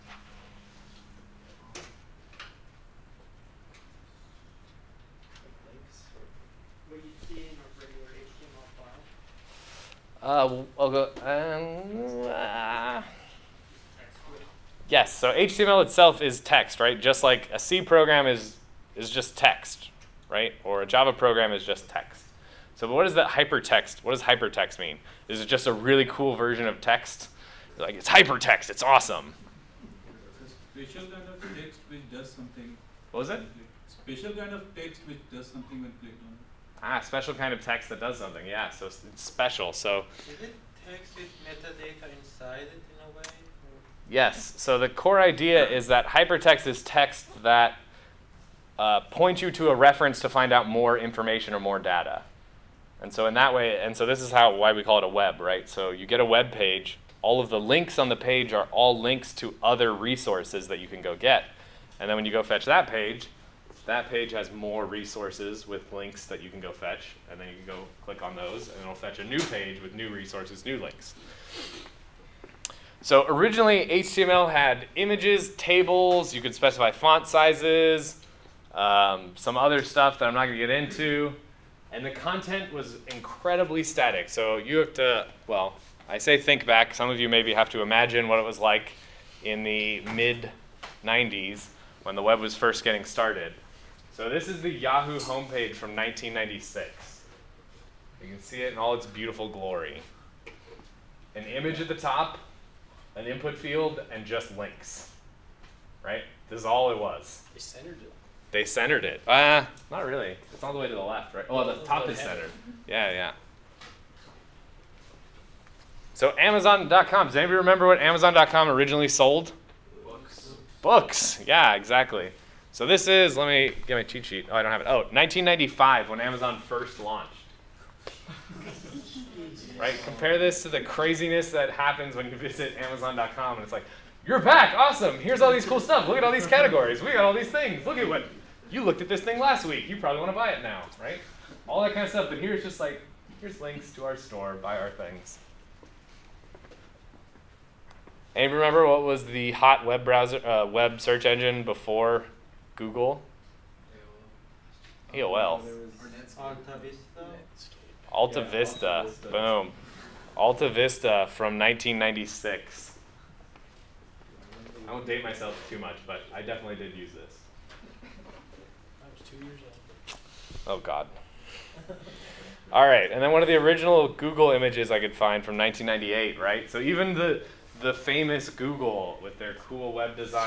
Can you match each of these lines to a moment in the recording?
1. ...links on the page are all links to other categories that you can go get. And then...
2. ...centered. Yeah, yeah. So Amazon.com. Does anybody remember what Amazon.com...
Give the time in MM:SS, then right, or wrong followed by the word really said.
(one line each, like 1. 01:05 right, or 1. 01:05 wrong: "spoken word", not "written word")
1. 00:57 wrong: "resources", not "categories"
2. 01:52 right.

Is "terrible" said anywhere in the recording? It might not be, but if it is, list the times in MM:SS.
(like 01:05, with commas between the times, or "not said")
not said.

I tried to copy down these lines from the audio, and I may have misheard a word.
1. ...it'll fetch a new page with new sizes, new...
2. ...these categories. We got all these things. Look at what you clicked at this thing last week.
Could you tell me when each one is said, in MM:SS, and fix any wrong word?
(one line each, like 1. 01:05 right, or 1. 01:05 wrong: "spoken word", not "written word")
1. 01:08 wrong: "resources", not "sizes"
2. 02:16 wrong: "looked", not "clicked".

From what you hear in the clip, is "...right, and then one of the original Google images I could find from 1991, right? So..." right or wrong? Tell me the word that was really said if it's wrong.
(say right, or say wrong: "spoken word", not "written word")
wrong: "1998", not "1991".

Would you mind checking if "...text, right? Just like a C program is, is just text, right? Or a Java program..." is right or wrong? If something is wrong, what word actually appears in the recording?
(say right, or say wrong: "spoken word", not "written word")
right.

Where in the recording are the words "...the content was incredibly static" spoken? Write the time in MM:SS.
01:22.